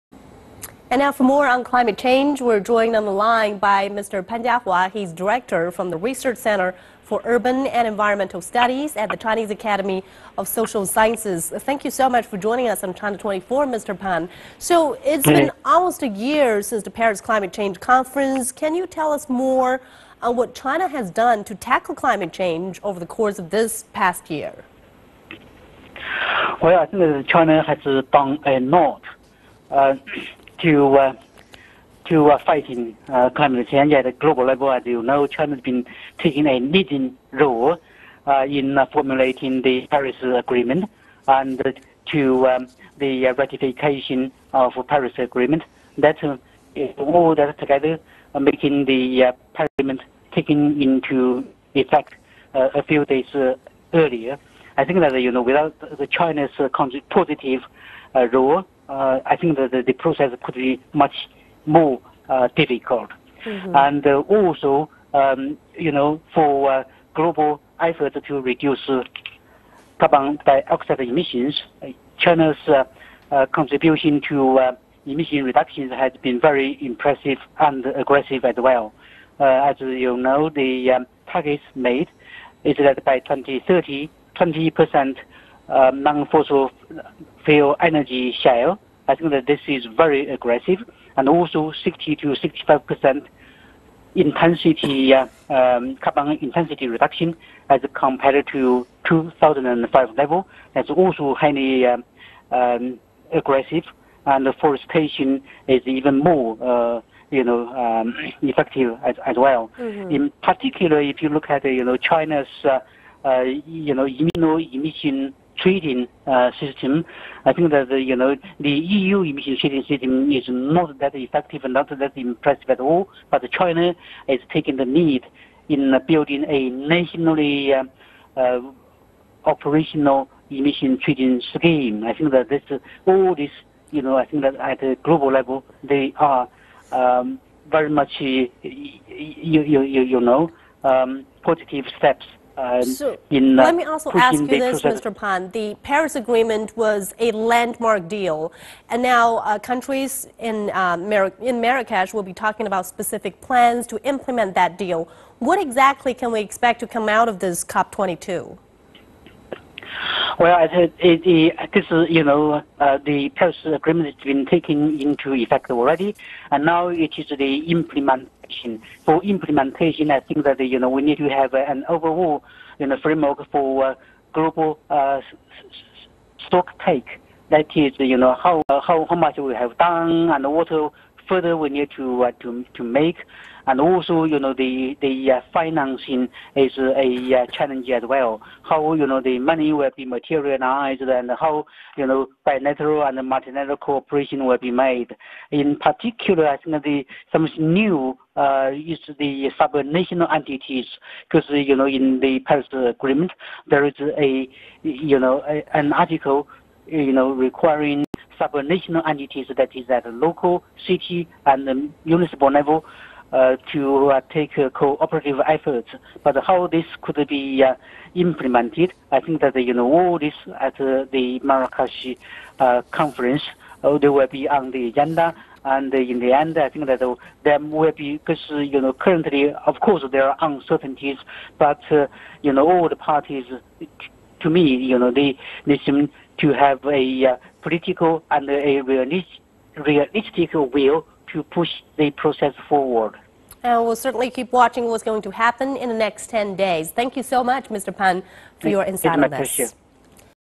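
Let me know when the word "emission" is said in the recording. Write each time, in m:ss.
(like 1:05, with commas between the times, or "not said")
1:10, 1:15, 1:54, 1:59, 2:10.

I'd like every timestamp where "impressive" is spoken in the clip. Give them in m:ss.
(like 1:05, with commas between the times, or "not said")
1:16, 2:02.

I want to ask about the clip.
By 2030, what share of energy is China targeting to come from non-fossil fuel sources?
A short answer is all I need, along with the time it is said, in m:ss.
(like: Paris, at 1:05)
20 percent, at 1:24.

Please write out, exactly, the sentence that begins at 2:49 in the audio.
For implementation, I think that, you know, we need to have an overall, you know, framework for uh, global uh, stock take.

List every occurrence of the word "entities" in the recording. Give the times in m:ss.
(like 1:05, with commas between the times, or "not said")
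3:20, 3:29.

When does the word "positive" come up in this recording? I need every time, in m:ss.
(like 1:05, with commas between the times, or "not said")
0:57, 2:21.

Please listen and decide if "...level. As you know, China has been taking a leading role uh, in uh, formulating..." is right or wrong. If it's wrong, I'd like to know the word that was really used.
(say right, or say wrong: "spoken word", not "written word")
right.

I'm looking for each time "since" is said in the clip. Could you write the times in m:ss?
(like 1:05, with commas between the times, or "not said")
0:16.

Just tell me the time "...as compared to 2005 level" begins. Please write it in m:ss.
1:37.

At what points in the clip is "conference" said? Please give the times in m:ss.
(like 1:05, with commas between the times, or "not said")
0:17, 3:42.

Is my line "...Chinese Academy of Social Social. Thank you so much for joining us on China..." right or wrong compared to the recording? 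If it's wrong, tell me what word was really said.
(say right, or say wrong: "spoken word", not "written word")
wrong: "Sciences", not "Social".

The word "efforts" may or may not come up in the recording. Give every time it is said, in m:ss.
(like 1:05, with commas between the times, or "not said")
1:07, 3:35.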